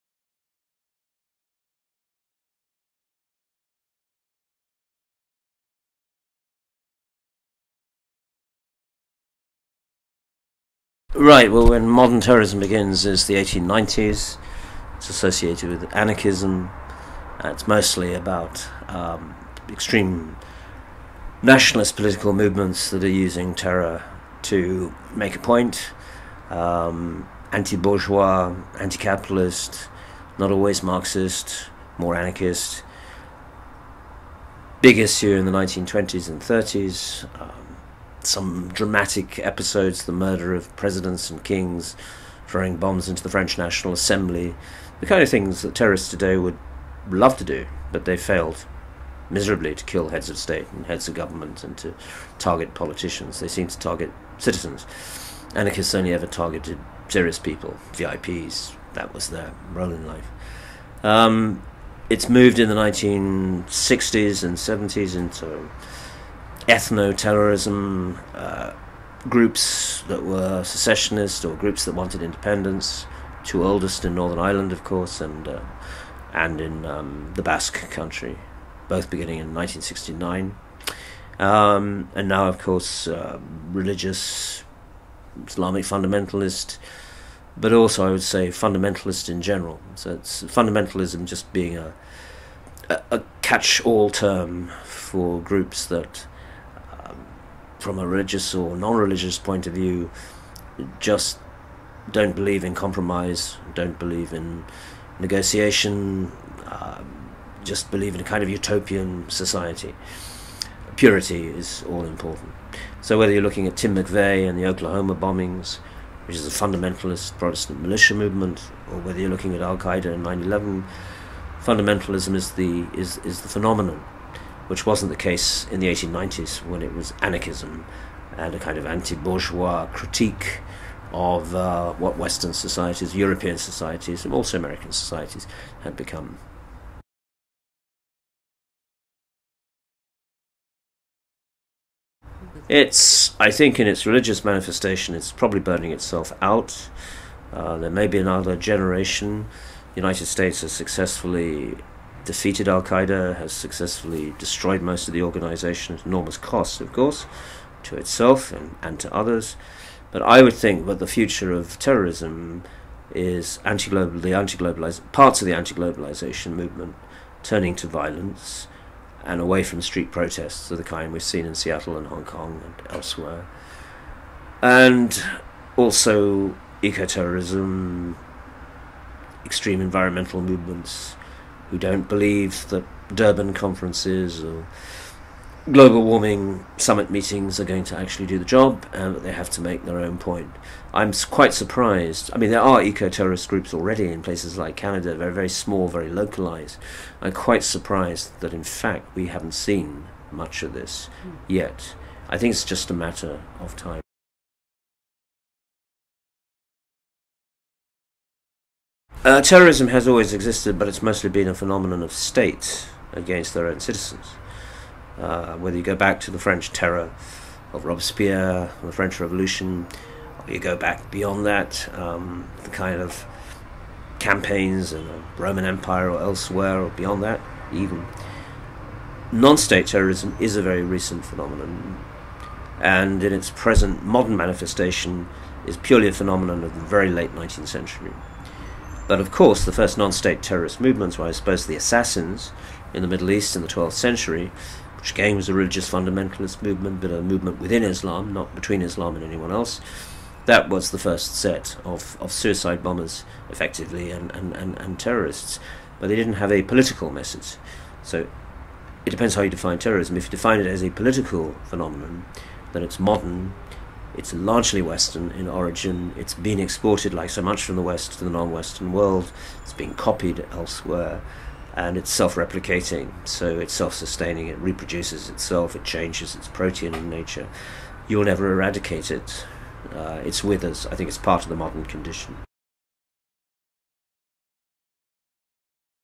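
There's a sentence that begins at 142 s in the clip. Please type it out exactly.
It's, I think, in its religious manifestation, it's probably burning itself out.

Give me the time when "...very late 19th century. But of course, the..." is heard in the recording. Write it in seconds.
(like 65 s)
236 s.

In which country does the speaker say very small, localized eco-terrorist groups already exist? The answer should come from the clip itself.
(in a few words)
Canada.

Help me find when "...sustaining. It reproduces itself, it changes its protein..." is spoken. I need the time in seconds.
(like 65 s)
273 s.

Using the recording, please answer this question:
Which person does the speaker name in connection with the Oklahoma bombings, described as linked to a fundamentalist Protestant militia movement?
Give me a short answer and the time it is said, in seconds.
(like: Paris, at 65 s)
Tim McVeigh, at 113 s.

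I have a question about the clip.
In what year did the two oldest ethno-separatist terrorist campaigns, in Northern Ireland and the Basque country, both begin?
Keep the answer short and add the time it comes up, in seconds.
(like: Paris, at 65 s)
1969, at 79 s.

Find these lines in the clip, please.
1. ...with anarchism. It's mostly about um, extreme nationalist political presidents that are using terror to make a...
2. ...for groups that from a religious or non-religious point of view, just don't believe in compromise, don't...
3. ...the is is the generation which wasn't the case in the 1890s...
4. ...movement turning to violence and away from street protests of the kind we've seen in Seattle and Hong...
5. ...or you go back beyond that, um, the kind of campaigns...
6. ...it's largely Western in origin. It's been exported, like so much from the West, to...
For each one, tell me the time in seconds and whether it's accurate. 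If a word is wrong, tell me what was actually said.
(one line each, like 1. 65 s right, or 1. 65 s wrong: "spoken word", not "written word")
1. 15 s wrong: "movements", not "presidents"
2. 94 s right
3. 122 s wrong: "phenomenon", not "generation"
4. 166 s right
5. 220 s right
6. 264 s right.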